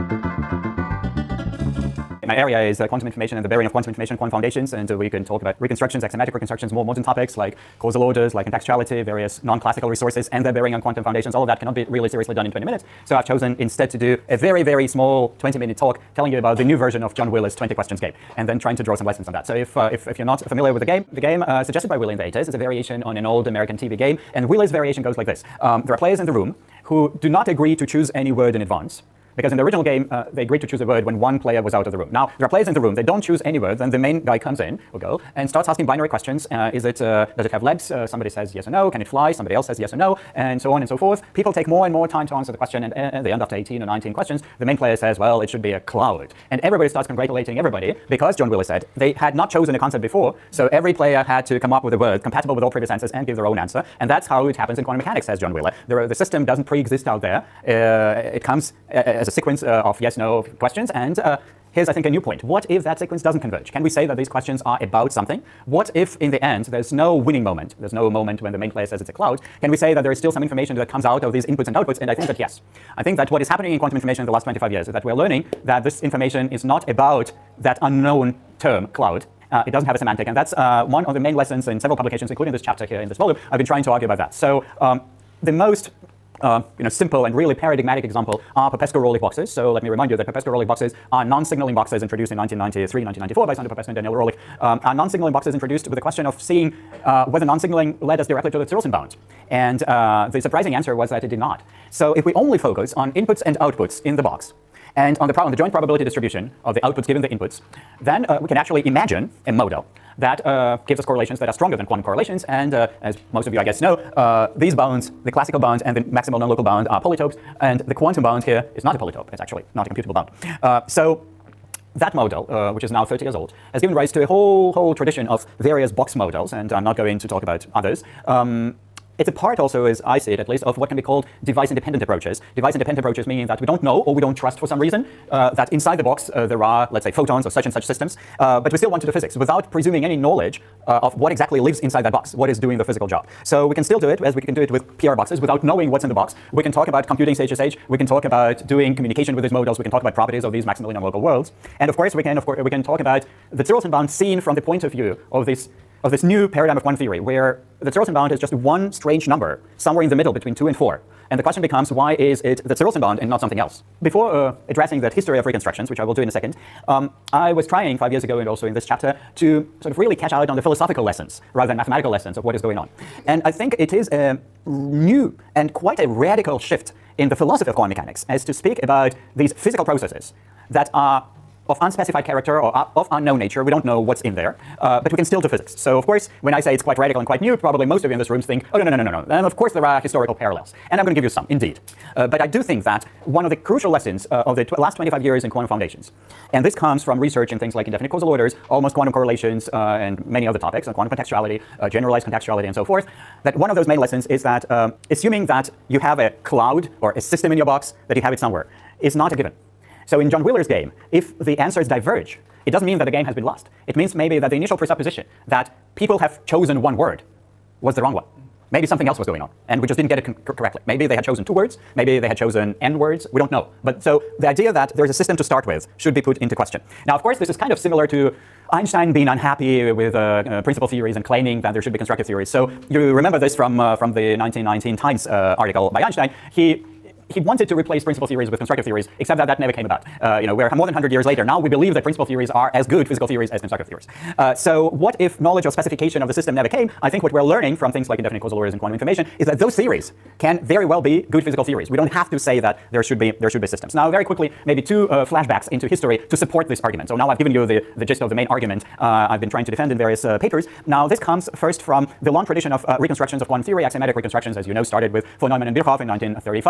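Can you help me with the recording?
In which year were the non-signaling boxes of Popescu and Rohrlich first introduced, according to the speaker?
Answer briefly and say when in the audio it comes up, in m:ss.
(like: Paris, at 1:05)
1993, at 1:32.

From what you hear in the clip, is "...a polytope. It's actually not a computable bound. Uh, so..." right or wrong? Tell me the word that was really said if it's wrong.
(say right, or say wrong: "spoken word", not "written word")
right.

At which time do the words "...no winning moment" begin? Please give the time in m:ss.
1:06.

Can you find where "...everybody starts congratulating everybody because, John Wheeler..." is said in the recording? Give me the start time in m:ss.
0:46.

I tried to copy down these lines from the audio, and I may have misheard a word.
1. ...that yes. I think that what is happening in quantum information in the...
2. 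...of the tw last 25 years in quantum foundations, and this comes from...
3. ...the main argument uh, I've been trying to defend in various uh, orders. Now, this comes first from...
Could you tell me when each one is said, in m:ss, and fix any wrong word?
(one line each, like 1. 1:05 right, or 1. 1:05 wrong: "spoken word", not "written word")
1. 1:12 right
2. 3:14 right
3. 4:18 wrong: "papers", not "orders".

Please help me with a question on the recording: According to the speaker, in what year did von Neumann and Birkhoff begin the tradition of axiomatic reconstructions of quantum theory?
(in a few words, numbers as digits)
1935.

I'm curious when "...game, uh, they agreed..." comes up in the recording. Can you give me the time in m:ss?
0:29.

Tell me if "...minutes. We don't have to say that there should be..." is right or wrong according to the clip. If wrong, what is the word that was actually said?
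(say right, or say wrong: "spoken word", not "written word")
wrong: "theories", not "minutes".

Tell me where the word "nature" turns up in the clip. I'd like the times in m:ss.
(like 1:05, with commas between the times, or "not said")
3:03.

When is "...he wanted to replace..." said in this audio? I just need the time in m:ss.
3:57.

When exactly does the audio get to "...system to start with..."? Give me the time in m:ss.
3:45.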